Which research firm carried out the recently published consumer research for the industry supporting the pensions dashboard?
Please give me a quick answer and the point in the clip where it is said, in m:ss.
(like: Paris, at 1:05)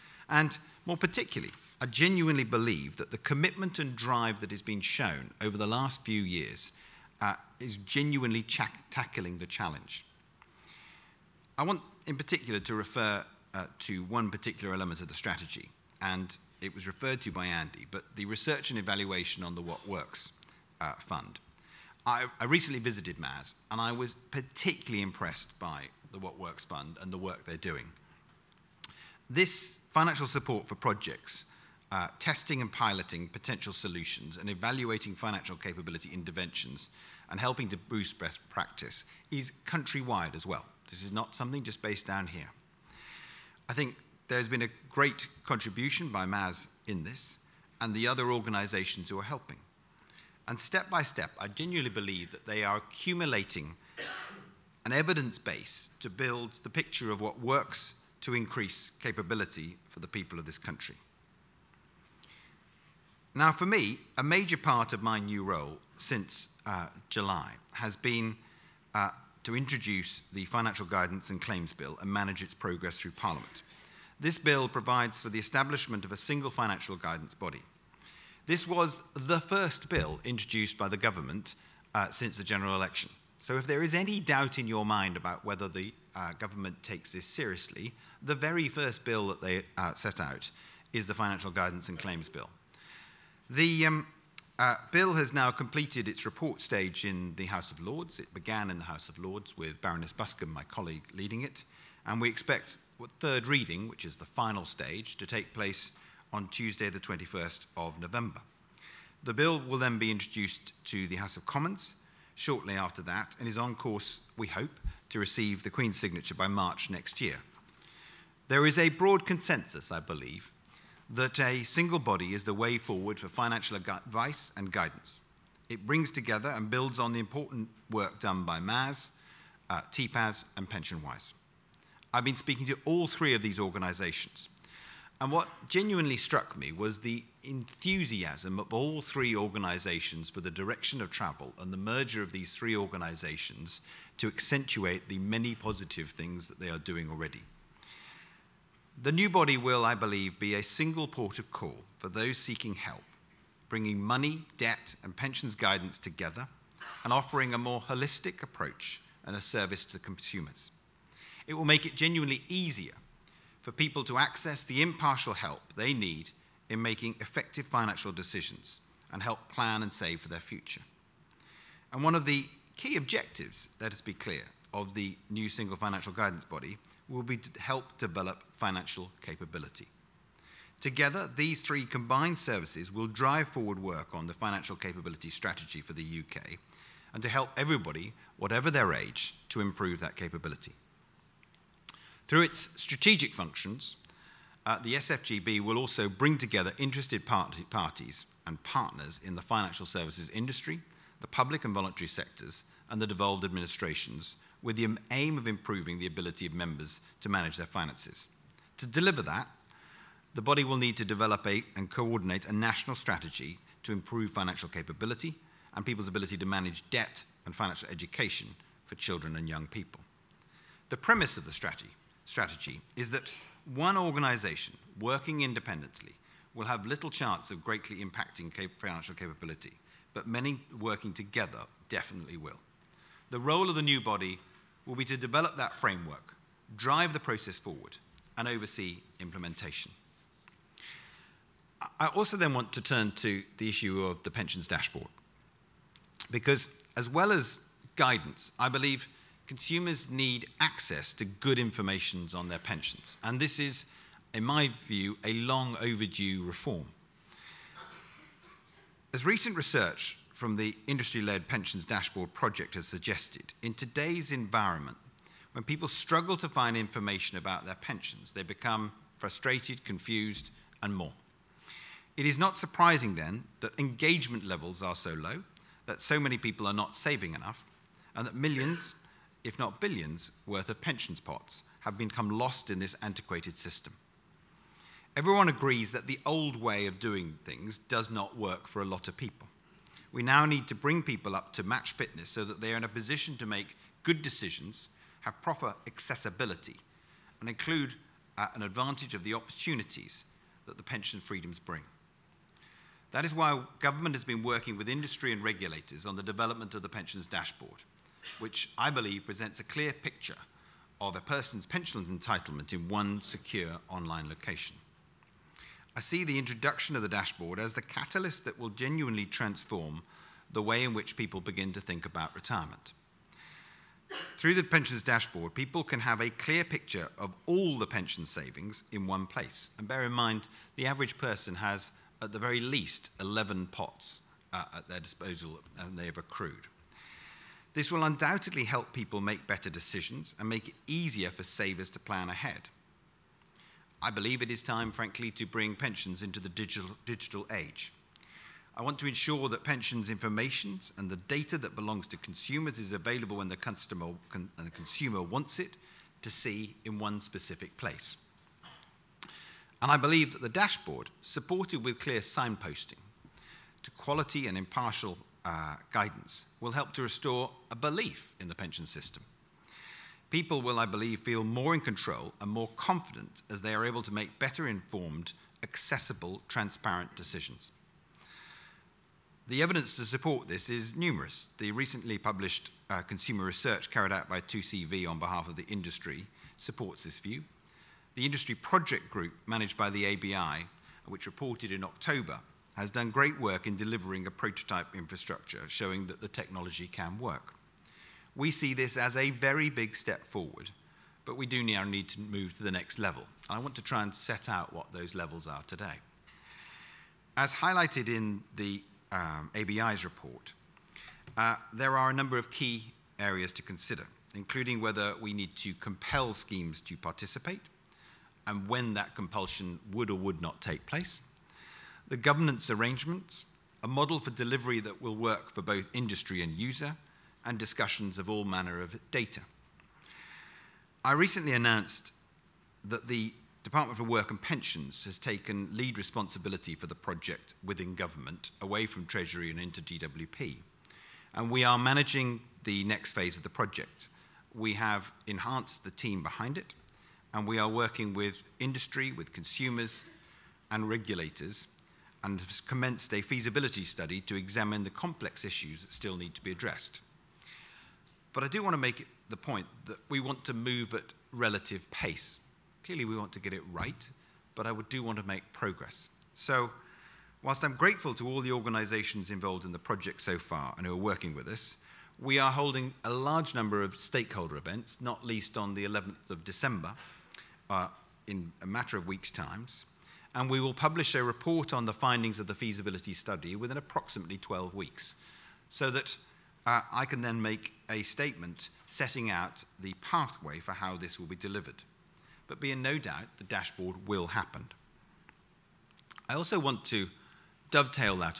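2CV, at 6:24.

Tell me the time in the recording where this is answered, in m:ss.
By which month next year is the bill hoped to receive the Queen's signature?
1:56.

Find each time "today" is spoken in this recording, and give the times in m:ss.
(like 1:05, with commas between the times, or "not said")
4:23, 6:45.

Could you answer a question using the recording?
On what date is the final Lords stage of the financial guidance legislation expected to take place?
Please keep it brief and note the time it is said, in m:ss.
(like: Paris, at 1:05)
21 November, at 1:46.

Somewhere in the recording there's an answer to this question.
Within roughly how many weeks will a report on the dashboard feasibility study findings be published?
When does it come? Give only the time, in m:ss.
8:04.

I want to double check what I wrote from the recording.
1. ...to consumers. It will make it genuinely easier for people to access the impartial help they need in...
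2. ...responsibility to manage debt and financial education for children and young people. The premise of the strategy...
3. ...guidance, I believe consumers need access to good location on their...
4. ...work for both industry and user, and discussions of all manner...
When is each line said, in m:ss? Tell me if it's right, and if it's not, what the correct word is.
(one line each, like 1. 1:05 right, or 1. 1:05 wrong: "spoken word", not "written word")
1. 2:39 right
2. 3:36 wrong: "ability", not "responsibility"
3. 4:07 wrong: "information", not "location"
4. 7:05 right.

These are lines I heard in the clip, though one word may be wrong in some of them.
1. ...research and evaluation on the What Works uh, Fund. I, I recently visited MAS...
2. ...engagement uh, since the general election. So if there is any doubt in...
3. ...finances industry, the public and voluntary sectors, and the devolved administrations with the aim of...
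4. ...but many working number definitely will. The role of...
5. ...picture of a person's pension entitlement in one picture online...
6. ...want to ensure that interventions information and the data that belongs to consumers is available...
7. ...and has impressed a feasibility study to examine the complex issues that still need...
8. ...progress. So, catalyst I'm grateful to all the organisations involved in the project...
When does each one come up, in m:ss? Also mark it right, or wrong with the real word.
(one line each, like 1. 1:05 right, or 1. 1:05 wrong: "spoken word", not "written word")
1. 0:18 right
2. 1:20 wrong: "government", not "engagement"
3. 3:19 wrong: "services", not "finances"
4. 3:50 wrong: "together", not "number"
5. 5:09 wrong: "secure", not "picture"
6. 5:48 wrong: "pensions", not "interventions"
7. 7:32 wrong: "commenced", not "impressed"
8. 7:45 wrong: "whilst", not "catalyst".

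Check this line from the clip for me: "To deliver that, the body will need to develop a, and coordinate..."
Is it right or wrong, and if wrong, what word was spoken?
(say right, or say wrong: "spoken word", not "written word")
right.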